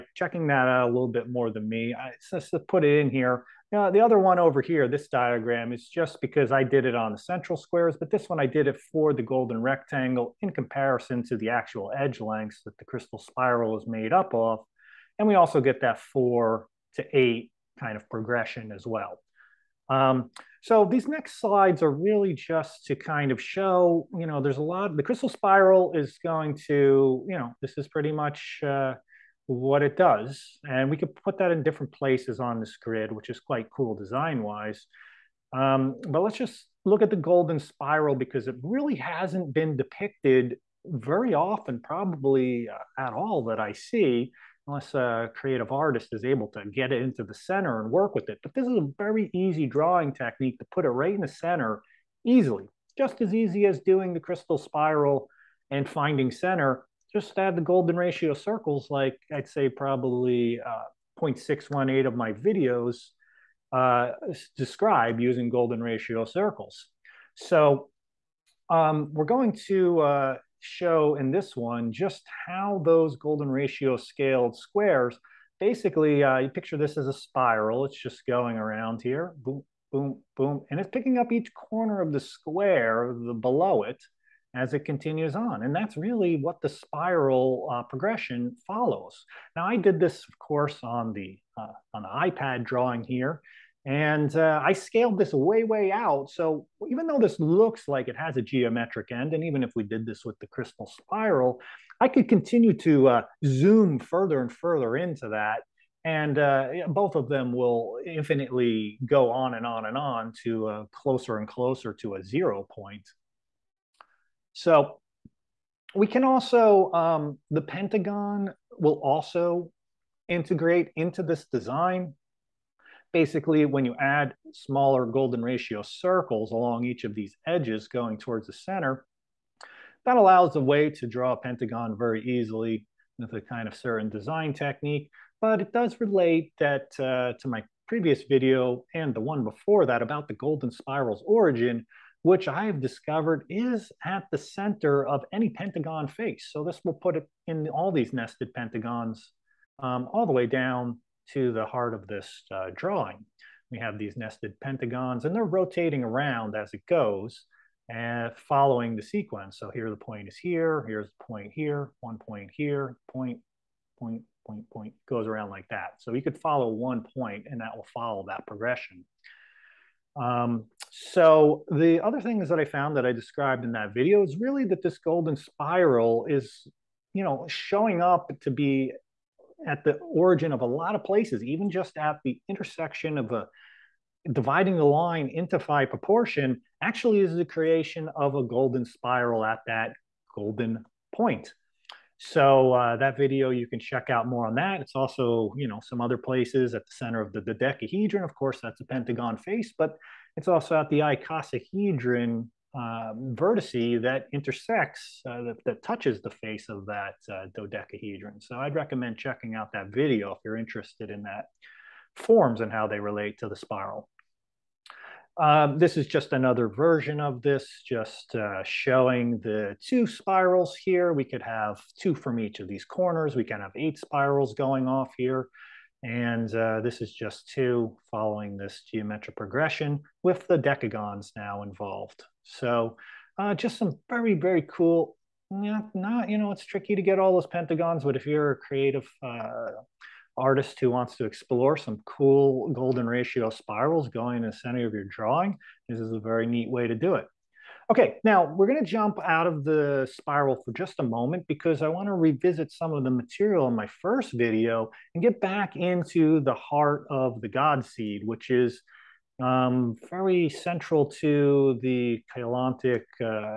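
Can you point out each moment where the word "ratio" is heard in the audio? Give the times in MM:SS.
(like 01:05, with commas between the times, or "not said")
00:57, 01:05, 01:13, 02:05, 04:03.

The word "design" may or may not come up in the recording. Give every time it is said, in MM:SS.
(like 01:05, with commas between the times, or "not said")
00:33, 02:01, 02:14.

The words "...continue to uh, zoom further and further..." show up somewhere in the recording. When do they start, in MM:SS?
01:42.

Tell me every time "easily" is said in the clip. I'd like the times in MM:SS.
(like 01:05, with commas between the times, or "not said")
00:52, 02:12.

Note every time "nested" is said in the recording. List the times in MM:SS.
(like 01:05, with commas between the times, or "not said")
02:28, 02:34.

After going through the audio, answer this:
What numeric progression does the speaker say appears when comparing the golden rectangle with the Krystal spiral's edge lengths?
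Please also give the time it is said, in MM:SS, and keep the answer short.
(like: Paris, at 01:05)
4 to 8, at 00:15.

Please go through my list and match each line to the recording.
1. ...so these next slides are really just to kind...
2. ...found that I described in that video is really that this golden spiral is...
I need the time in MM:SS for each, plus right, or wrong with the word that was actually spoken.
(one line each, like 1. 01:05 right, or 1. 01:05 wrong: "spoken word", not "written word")
1. 00:20 right
2. 02:52 right.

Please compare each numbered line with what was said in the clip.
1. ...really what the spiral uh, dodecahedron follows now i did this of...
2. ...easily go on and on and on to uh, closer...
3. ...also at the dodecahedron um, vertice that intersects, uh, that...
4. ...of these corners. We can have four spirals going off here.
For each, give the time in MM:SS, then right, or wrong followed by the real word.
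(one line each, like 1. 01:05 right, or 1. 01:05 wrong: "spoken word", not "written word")
1. 01:25 wrong: "progression", not "dodecahedron"
2. 01:48 wrong: "infinitely", not "easily"
3. 03:20 wrong: "icosahedron", not "dodecahedron"
4. 03:42 wrong: "eight", not "four".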